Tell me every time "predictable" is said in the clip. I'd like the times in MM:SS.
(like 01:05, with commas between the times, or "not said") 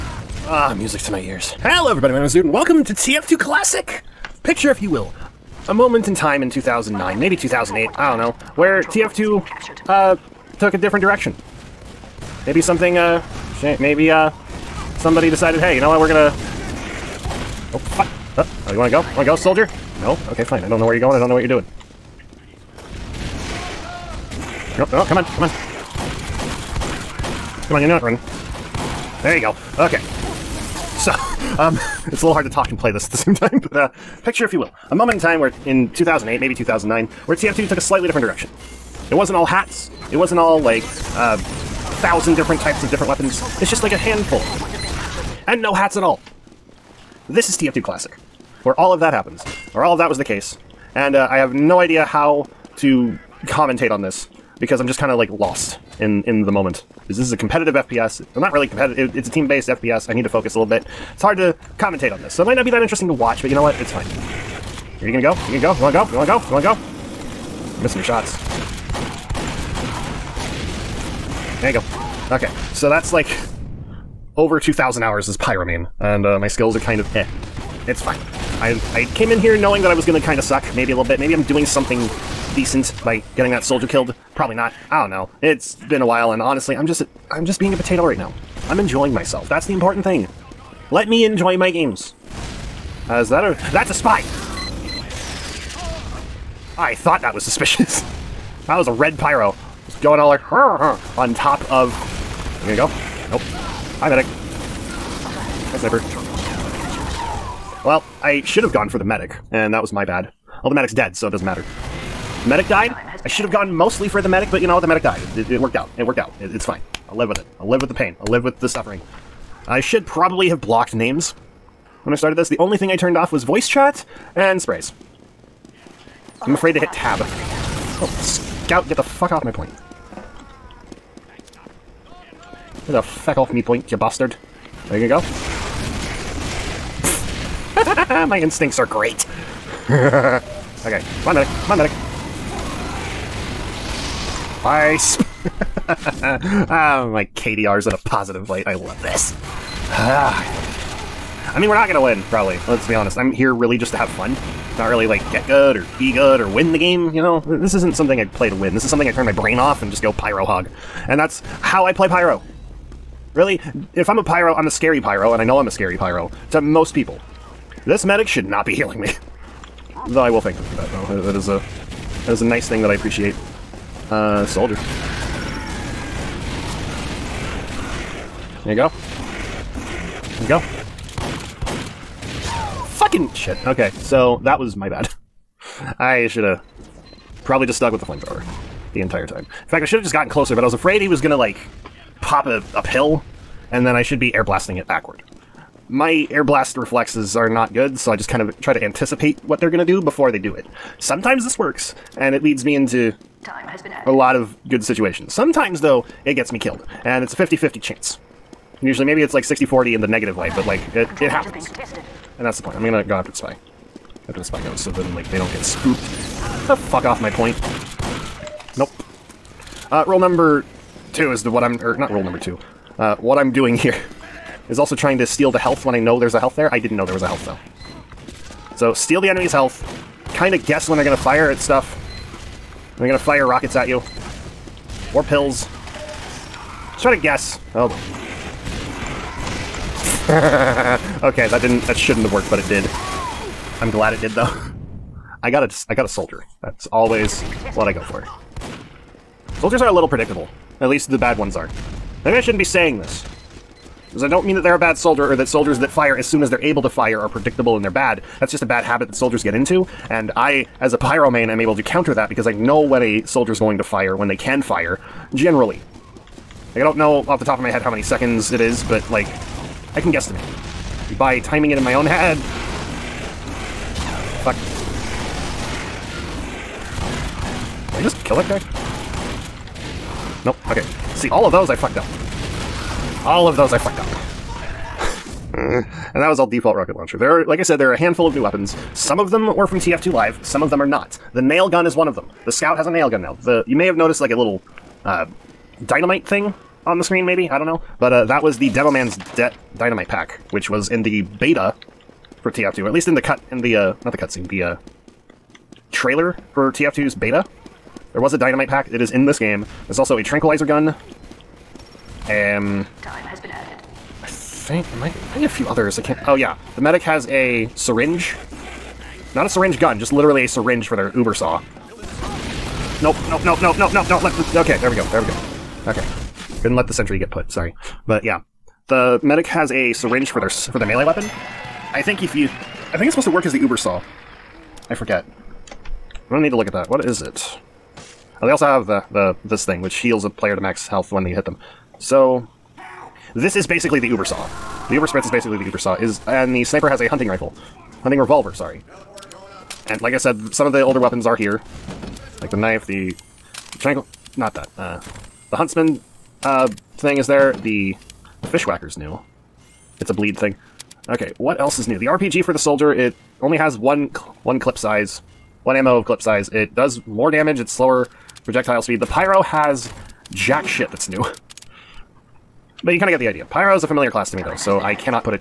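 04:10, 04:17.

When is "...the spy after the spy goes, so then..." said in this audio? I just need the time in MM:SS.
03:33.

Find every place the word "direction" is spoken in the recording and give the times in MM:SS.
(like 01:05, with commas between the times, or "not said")
00:11, 00:38.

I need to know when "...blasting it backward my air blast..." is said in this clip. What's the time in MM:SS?
03:14.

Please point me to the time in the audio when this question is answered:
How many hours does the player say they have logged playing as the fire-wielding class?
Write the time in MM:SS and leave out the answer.
01:14.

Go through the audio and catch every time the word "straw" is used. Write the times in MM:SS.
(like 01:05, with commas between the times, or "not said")
not said.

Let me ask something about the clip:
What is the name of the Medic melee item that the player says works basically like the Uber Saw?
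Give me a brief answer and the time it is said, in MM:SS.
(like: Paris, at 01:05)
Uber spritz, at 05:44.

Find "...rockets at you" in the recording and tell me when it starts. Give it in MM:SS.
03:53.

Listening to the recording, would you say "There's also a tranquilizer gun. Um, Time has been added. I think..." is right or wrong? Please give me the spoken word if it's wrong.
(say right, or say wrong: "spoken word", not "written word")
right.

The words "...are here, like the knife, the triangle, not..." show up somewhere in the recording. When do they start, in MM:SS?
05:51.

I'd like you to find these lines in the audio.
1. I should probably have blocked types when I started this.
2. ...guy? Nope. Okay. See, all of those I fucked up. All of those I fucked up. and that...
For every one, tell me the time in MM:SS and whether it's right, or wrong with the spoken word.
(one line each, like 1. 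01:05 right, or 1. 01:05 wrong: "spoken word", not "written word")
1. 01:59 wrong: "names", not "types"
2. 04:38 right.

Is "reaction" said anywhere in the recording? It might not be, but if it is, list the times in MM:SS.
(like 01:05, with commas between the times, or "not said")
not said.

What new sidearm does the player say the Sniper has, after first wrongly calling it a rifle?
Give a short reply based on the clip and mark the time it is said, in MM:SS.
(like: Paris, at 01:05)
hunting revolver, at 05:48.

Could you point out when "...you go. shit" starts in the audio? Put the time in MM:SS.
03:00.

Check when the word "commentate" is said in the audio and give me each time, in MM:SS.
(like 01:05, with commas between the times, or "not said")
00:53, 01:01.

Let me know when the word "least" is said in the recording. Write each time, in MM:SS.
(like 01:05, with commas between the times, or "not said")
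04:10, 05:02.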